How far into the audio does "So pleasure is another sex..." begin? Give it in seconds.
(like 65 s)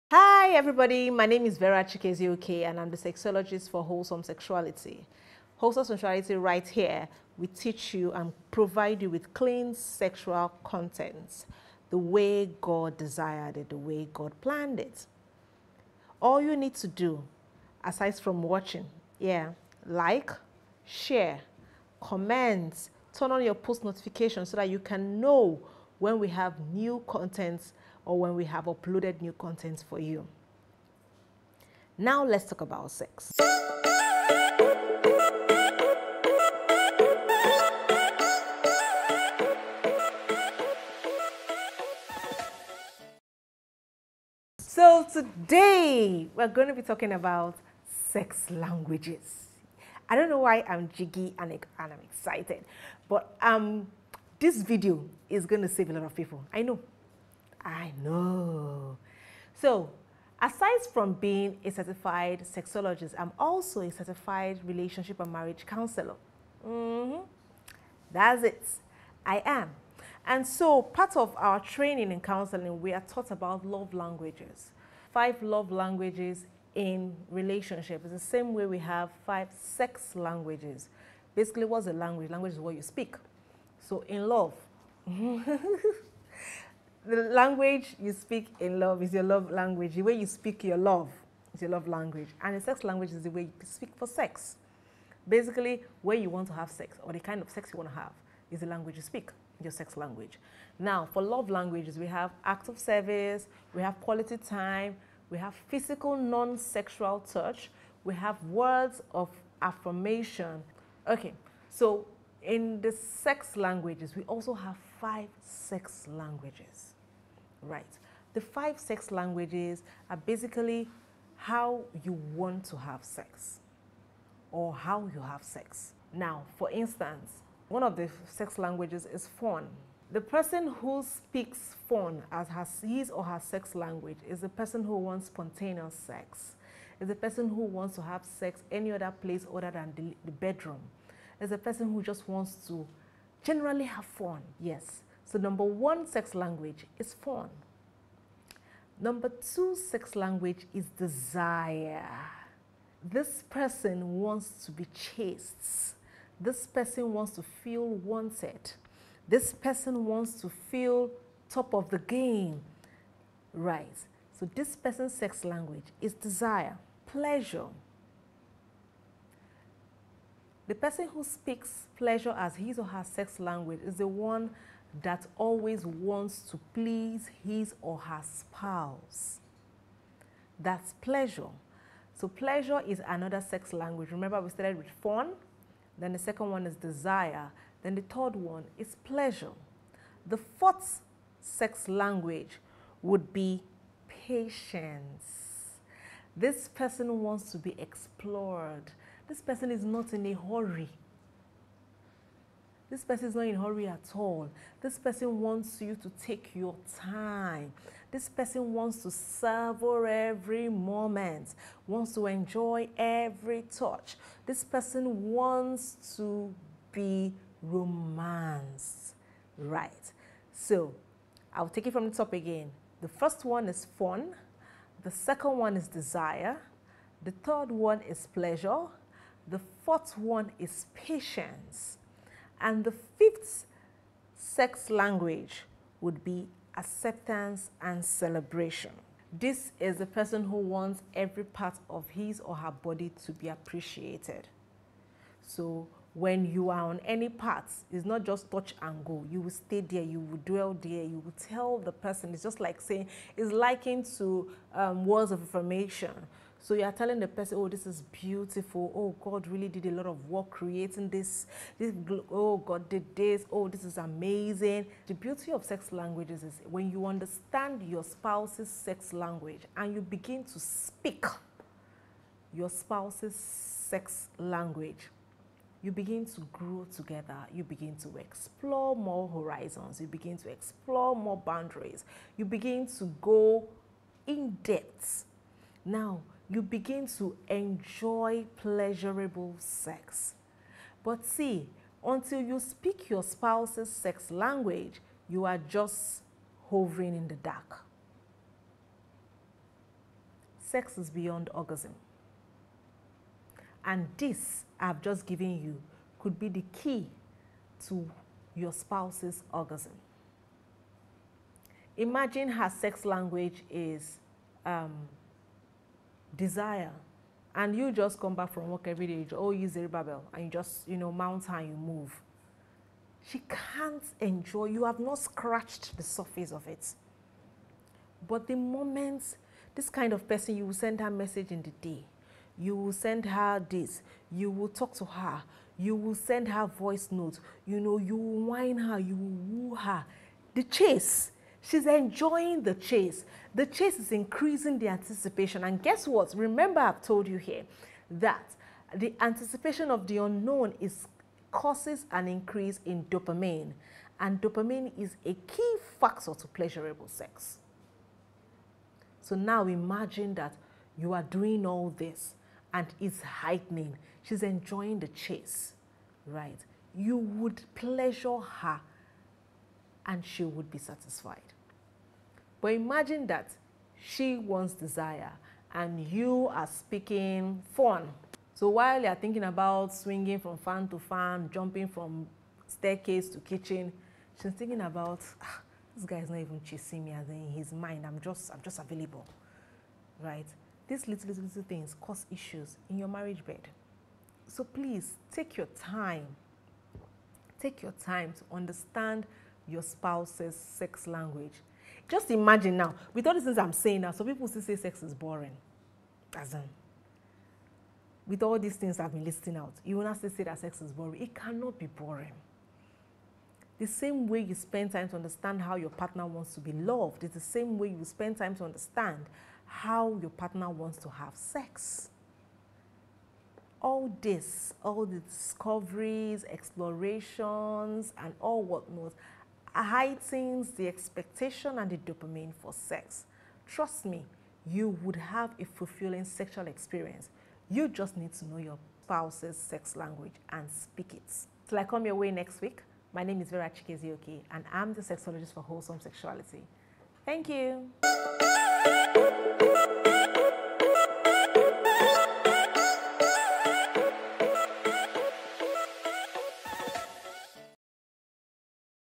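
182 s.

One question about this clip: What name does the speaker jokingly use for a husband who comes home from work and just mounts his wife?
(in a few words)
Zerubbabel.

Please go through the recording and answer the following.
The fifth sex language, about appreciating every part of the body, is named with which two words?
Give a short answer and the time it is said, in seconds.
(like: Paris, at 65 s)
acceptance and celebration, at 236 s.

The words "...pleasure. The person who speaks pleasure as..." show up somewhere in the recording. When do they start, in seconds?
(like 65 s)
167 s.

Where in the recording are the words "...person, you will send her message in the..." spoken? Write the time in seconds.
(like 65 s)
330 s.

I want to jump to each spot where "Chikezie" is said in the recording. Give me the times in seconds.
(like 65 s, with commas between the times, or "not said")
1 s, 443 s.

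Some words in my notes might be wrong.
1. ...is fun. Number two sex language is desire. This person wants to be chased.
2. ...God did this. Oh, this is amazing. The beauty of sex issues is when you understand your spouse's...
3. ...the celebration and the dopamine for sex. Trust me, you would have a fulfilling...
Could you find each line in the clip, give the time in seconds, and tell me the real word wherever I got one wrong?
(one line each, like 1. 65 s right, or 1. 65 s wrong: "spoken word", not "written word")
1. 146 s right
2. 262 s wrong: "languages", not "issues"
3. 430 s wrong: "expectation", not "celebration".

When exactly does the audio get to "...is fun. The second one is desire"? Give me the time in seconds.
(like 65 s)
223 s.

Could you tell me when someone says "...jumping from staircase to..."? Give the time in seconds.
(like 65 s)
381 s.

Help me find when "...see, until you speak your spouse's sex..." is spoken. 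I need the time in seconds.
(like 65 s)
291 s.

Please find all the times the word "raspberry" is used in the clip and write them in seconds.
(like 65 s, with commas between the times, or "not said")
not said.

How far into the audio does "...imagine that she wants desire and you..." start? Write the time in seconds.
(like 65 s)
372 s.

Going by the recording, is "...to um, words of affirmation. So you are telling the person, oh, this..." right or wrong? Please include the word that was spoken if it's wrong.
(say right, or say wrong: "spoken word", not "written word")
right.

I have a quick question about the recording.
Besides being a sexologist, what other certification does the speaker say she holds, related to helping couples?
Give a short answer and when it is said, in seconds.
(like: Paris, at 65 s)
relationship and marriage counselor, at 64 s.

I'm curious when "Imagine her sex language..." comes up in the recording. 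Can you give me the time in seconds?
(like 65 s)
311 s.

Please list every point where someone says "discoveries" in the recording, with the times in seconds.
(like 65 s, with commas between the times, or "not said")
425 s.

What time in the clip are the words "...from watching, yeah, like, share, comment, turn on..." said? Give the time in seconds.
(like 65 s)
18 s.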